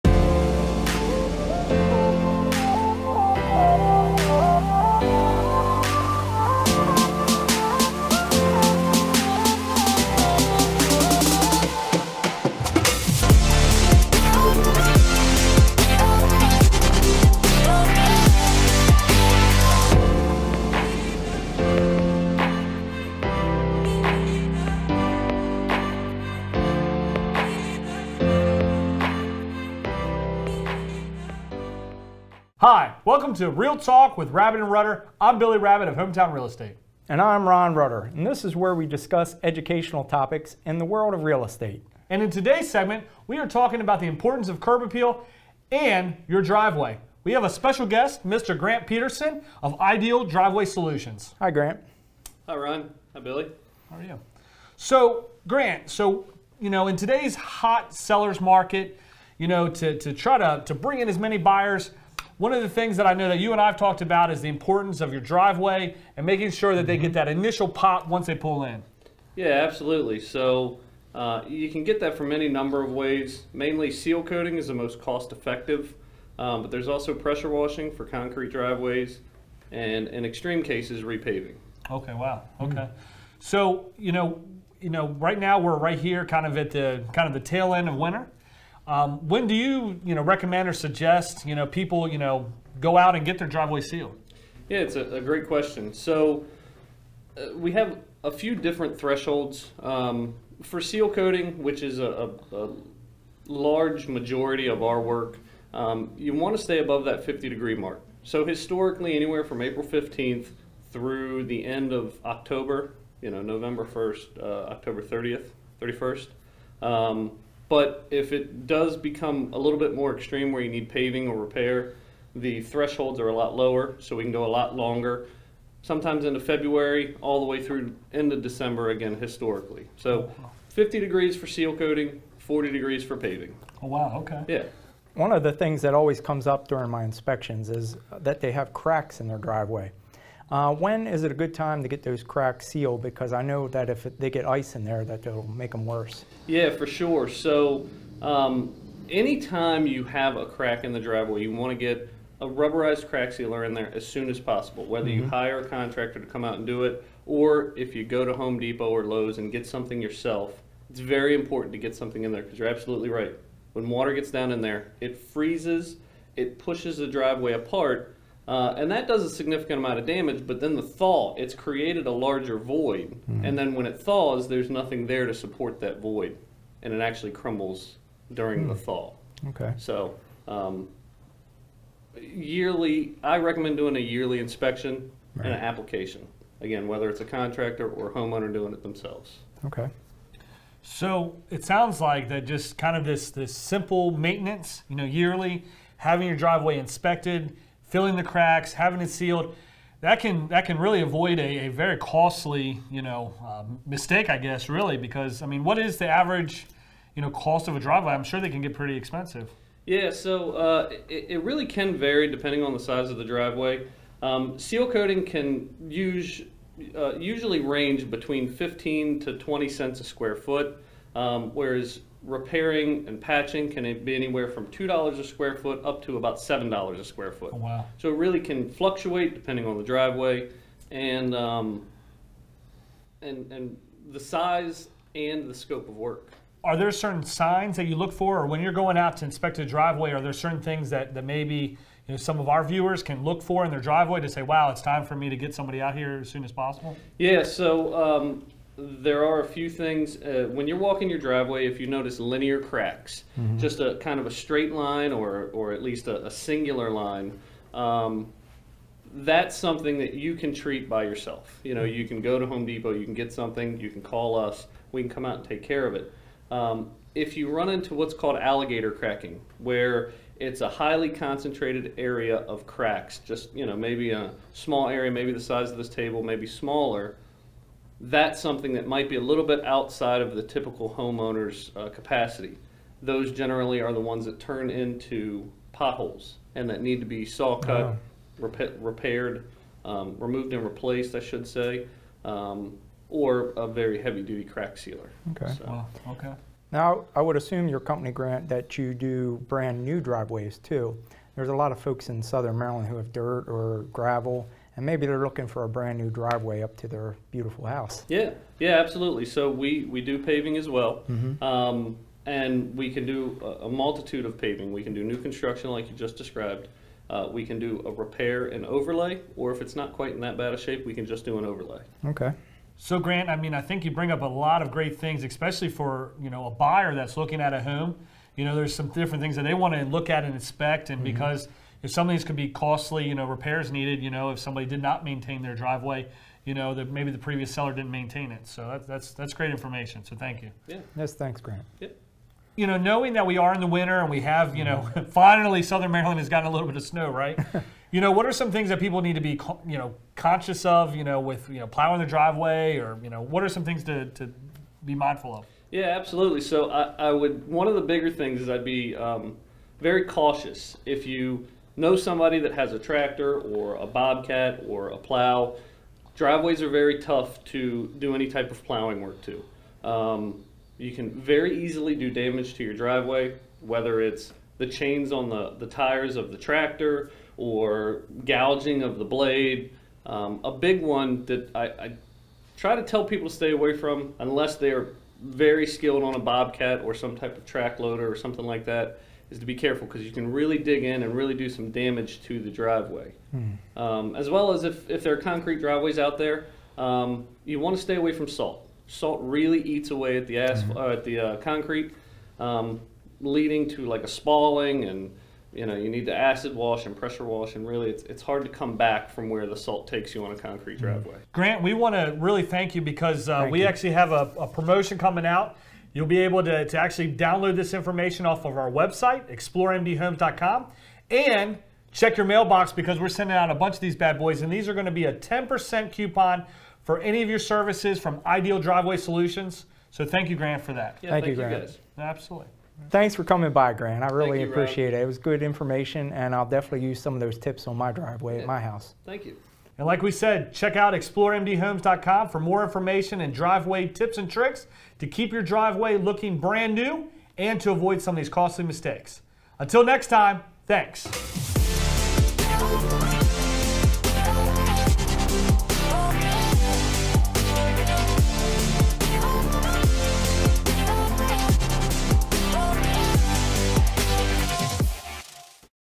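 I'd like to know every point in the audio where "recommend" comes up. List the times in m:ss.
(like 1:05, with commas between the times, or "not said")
1:30, 3:03.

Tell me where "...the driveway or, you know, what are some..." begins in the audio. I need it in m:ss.
5:51.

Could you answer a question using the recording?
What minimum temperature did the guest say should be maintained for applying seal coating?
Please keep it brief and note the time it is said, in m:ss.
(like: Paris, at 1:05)
50 degrees, at 1:47.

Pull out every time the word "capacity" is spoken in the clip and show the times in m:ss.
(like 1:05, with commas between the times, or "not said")
4:41.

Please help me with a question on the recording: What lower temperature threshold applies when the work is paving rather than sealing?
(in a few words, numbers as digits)
40 degrees.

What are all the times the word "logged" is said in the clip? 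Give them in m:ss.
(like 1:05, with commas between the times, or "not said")
not said.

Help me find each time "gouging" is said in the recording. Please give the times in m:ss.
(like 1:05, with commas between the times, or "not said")
6:18.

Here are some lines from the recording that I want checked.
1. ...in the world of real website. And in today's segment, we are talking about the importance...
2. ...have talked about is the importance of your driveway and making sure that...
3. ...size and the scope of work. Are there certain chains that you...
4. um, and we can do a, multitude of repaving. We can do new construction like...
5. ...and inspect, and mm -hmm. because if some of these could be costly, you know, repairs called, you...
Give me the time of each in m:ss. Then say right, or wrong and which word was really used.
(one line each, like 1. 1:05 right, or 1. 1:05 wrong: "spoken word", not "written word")
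1. 0:40 wrong: "estate", not "website"
2. 1:03 right
3. 3:54 wrong: "signs", not "chains"
4. 5:11 wrong: "paving", not "repaving"
5. 5:30 wrong: "needed", not "called".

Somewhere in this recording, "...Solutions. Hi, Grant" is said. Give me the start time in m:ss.
0:50.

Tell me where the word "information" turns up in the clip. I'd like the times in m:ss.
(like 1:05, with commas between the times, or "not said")
5:39, 6:57, 7:15, 7:22.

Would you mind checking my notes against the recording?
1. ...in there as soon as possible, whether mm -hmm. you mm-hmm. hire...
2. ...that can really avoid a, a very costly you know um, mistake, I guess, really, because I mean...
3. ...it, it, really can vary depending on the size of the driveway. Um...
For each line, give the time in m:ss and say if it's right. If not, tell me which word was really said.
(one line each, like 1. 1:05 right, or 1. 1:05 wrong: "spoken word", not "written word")
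1. 2:33 right
2. 3:20 right
3. 3:31 right.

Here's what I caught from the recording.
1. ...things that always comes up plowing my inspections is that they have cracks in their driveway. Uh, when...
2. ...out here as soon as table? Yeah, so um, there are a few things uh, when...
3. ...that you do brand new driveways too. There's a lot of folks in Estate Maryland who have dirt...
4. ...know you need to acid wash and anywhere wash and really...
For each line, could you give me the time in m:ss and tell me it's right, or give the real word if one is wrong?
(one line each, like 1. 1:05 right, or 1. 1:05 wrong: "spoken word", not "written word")
1. 2:15 wrong: "during", not "plowing"
2. 4:05 wrong: "possible", not "table"
3. 4:58 wrong: "Southern", not "Estate"
4. 6:45 wrong: "pressure", not "anywhere".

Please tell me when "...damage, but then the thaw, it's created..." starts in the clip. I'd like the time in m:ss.
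2:50.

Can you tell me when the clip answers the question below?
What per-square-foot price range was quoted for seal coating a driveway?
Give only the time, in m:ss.
3:38.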